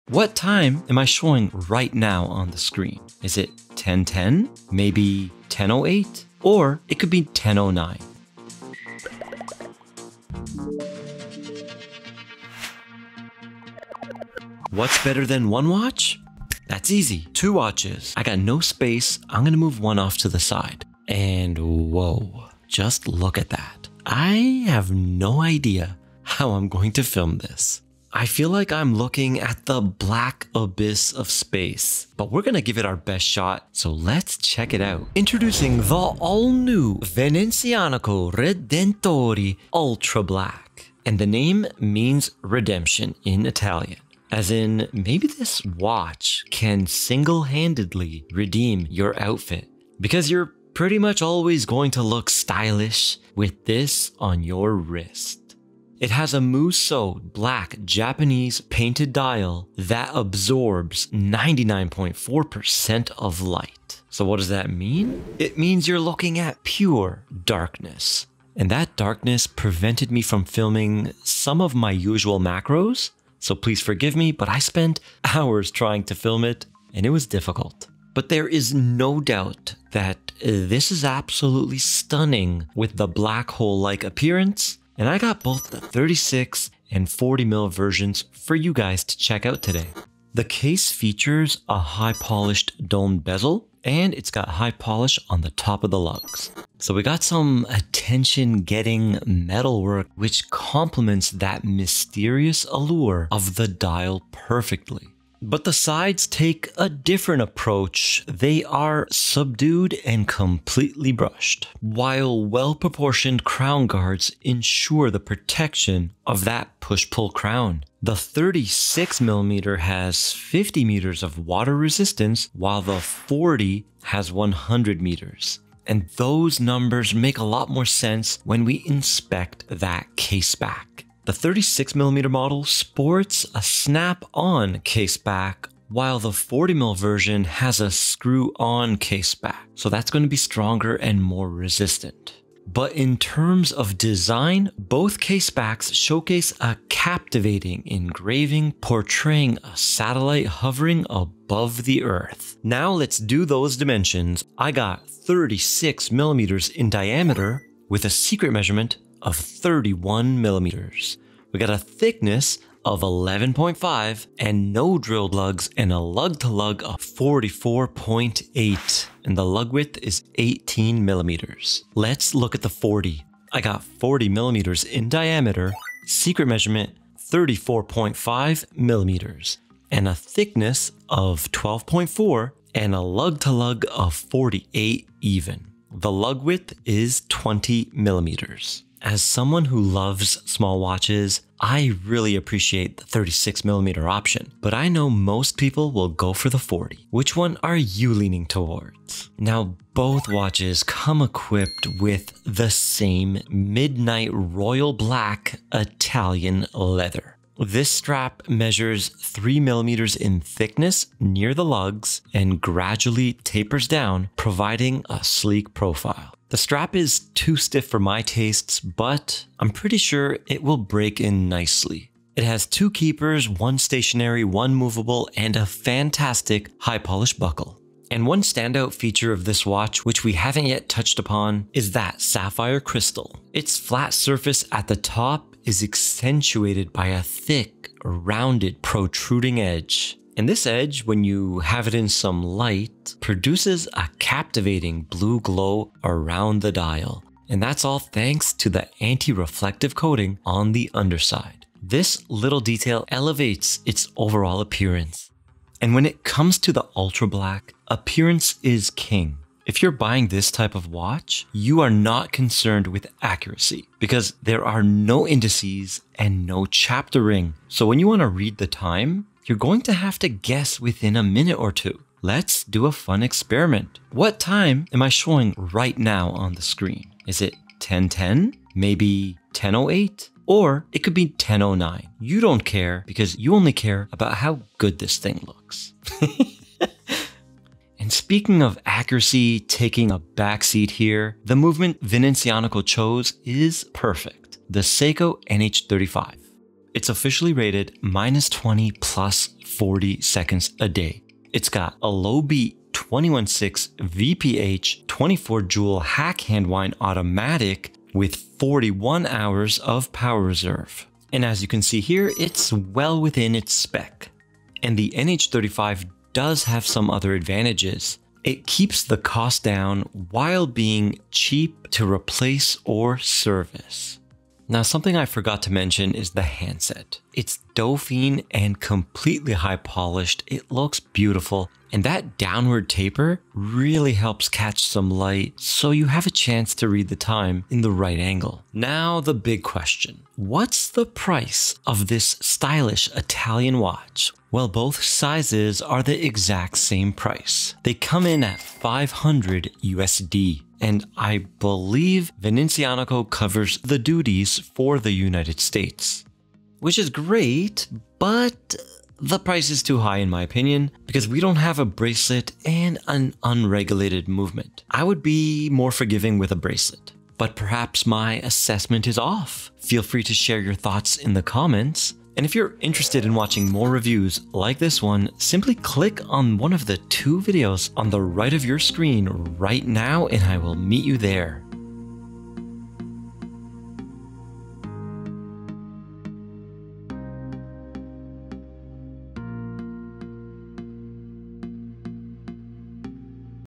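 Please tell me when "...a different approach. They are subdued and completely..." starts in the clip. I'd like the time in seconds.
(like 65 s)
106 s.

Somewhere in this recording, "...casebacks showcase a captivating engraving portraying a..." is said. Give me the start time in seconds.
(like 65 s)
145 s.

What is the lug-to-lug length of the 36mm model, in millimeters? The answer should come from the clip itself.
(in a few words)
44.8.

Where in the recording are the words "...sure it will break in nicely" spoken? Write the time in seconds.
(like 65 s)
219 s.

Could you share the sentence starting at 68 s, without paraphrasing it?
And that darkness prevented me from filming some of my usual macros.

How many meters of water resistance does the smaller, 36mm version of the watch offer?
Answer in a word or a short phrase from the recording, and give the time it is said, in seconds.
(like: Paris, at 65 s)
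50 meters, at 120 s.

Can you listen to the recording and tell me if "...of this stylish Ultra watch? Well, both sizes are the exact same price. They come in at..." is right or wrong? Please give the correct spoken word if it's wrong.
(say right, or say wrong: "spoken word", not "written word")
wrong: "Italian", not "Ultra".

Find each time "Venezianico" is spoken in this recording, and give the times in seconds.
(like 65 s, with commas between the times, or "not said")
36 s, 292 s, 352 s.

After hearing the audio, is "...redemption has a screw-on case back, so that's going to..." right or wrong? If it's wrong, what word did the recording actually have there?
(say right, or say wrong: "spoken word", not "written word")
wrong: "version", not "redemption".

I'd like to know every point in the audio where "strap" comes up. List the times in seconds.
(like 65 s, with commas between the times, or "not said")
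207 s, 216 s.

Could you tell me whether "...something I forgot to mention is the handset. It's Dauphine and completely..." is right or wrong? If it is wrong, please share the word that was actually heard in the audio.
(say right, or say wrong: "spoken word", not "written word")
right.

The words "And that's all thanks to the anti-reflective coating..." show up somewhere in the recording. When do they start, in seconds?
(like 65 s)
247 s.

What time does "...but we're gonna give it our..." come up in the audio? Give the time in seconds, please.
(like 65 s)
32 s.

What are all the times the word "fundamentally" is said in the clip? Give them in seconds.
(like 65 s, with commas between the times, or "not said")
not said.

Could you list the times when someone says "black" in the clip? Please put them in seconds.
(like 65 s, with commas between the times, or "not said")
29 s, 40 s, 57 s, 83 s, 204 s, 257 s.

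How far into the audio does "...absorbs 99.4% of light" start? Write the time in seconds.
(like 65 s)
60 s.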